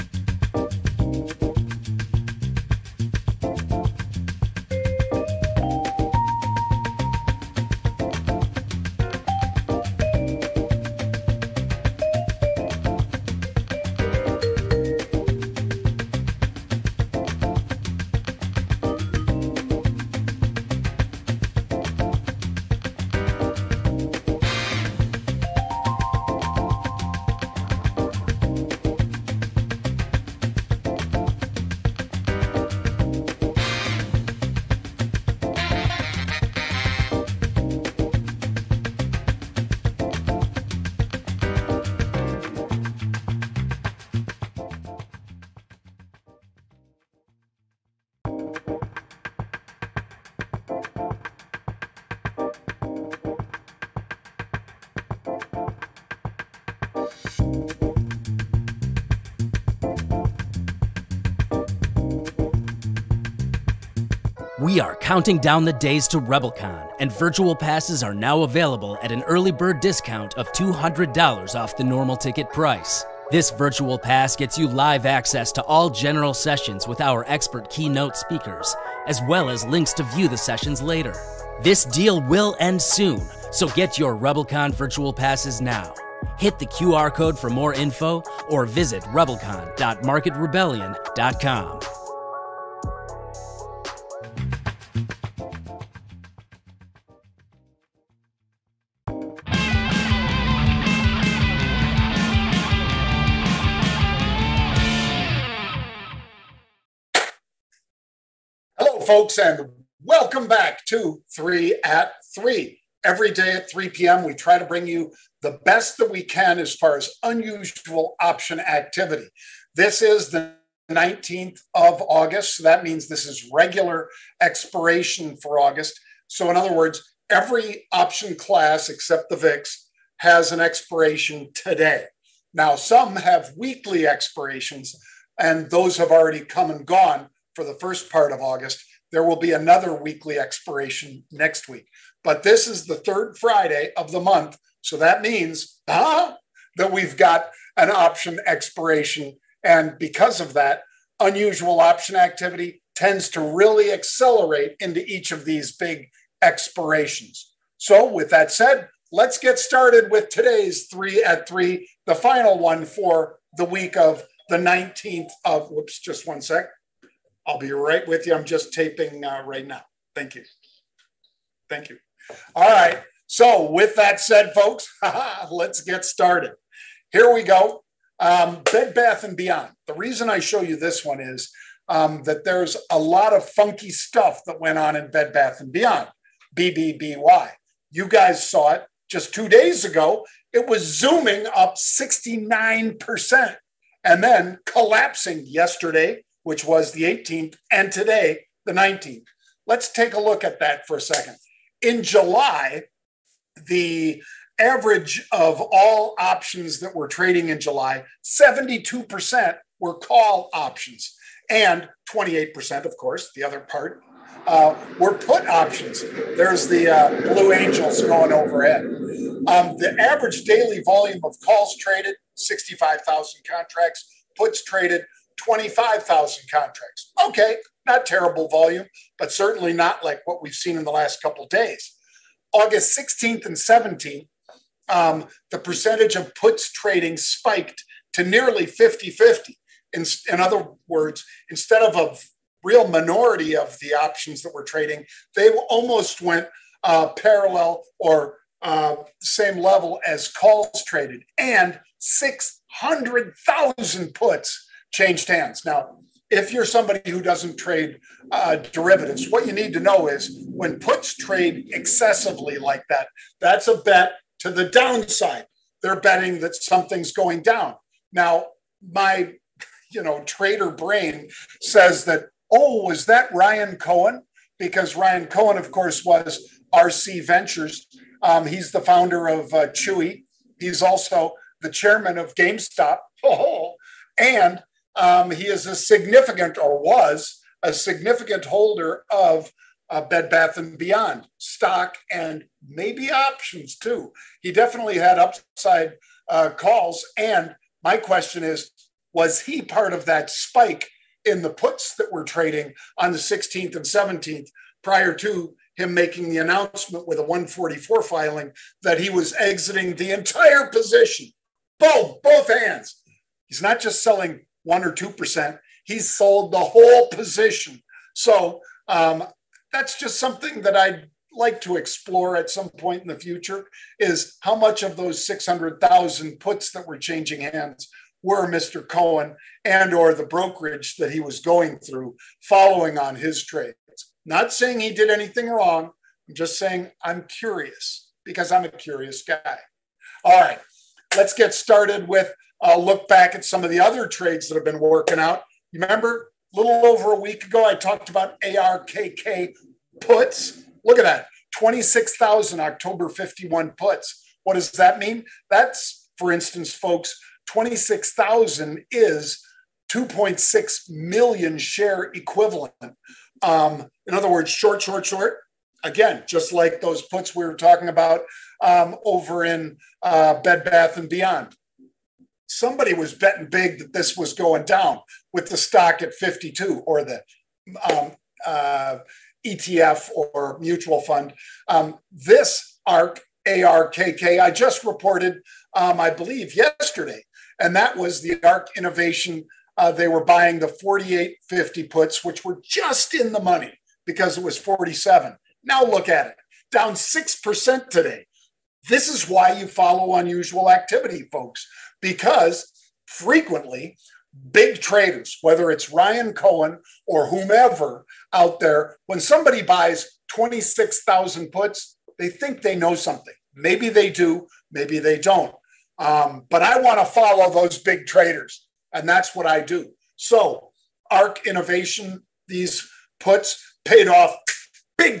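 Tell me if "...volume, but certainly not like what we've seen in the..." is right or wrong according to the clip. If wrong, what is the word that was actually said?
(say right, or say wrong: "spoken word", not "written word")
right.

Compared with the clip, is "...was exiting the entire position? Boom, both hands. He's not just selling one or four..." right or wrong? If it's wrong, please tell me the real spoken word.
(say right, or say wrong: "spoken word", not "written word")
wrong: "two", not "four".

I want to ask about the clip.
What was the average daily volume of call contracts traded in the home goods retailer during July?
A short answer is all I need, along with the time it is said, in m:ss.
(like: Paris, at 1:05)
65,000, at 3:42.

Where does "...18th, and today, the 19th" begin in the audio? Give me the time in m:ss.
3:17.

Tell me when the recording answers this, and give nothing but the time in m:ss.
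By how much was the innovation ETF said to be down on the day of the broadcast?
6:36.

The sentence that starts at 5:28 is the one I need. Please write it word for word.
Cohen and or the brokerage that he was going through following on his trades.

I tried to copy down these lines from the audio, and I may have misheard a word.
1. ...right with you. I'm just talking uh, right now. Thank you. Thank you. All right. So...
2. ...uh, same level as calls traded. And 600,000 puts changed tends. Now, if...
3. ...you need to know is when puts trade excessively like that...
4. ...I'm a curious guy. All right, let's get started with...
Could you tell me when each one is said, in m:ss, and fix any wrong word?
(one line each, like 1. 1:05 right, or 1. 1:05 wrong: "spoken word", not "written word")
1. 2:47 wrong: "taping", not "talking"
2. 4:08 wrong: "hands", not "tends"
3. 4:19 right
4. 5:38 right.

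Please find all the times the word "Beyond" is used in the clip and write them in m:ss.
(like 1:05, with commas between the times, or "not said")
2:59, 3:05, 4:50, 6:11.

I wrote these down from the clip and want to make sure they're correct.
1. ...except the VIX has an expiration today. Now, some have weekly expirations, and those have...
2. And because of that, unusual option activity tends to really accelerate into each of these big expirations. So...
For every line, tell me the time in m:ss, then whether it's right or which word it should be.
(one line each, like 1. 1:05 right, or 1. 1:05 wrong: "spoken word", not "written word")
1. 2:08 right
2. 2:29 right.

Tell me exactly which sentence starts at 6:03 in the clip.
Um, in other words, short, short, short.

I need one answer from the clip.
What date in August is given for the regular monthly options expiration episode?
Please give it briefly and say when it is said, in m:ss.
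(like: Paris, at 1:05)
19th, at 2:00.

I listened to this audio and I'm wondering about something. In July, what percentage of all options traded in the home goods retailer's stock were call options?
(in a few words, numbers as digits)
72%.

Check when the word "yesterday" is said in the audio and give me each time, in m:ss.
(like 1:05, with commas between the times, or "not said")
3:15, 6:26.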